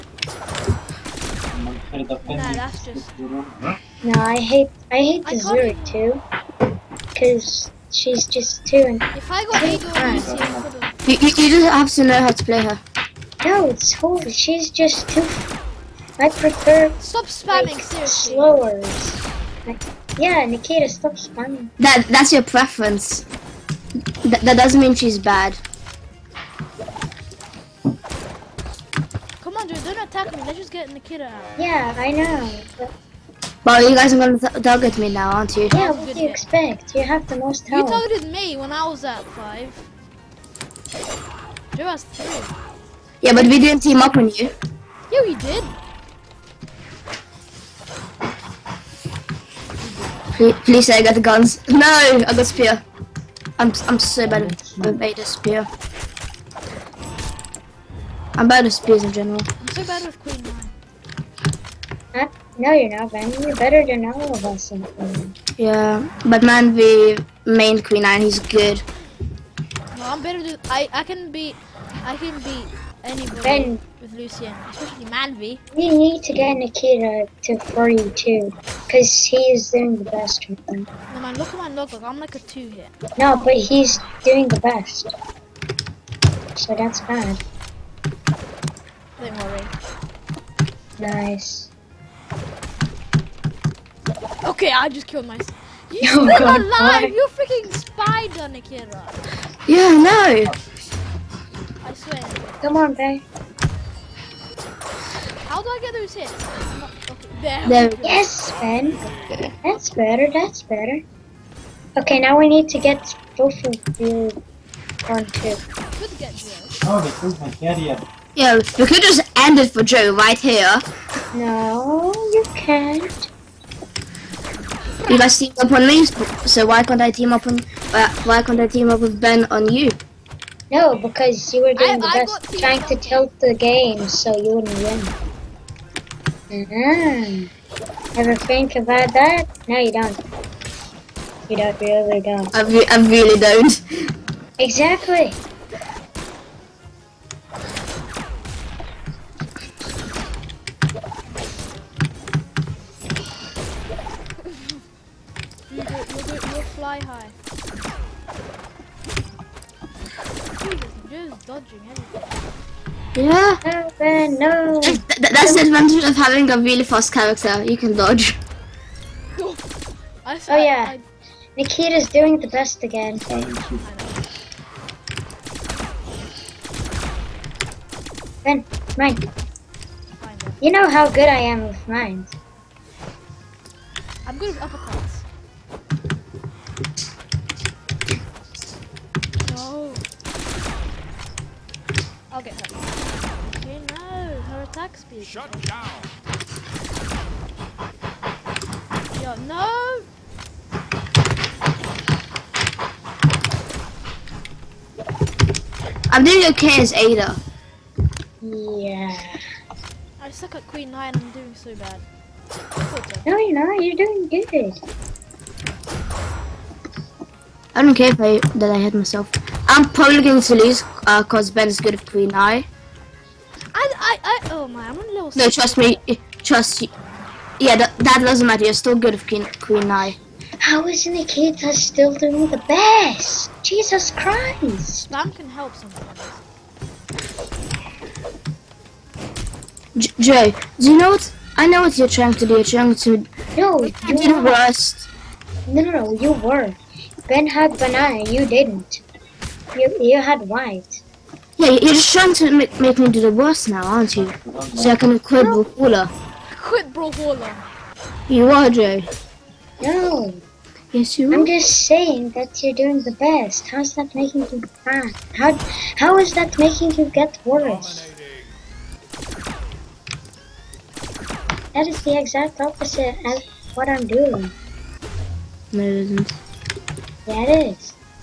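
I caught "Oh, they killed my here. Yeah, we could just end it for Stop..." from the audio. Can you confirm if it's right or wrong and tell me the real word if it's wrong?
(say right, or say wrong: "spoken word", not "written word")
wrong: "Joe", not "Stop".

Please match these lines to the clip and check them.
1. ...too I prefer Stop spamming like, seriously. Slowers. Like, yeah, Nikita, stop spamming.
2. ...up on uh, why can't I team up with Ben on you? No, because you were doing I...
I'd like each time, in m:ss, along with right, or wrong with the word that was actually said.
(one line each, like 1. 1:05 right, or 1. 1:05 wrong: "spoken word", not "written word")
1. 0:15 right
2. 2:07 right.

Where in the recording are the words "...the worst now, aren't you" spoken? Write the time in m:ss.
4:13.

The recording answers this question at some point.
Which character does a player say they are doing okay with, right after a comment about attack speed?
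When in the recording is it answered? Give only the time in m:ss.
3:26.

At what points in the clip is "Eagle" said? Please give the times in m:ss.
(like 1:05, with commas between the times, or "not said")
0:09.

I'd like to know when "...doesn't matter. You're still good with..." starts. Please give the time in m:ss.
3:48.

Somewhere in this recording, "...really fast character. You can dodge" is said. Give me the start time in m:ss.
2:46.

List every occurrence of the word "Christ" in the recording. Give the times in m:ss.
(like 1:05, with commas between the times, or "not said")
3:54.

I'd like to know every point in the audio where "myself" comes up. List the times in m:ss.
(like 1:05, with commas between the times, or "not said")
1:35, 3:38.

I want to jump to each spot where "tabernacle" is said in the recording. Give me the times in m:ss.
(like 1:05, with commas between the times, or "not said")
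not said.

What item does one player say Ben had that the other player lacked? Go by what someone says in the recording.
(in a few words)
banana.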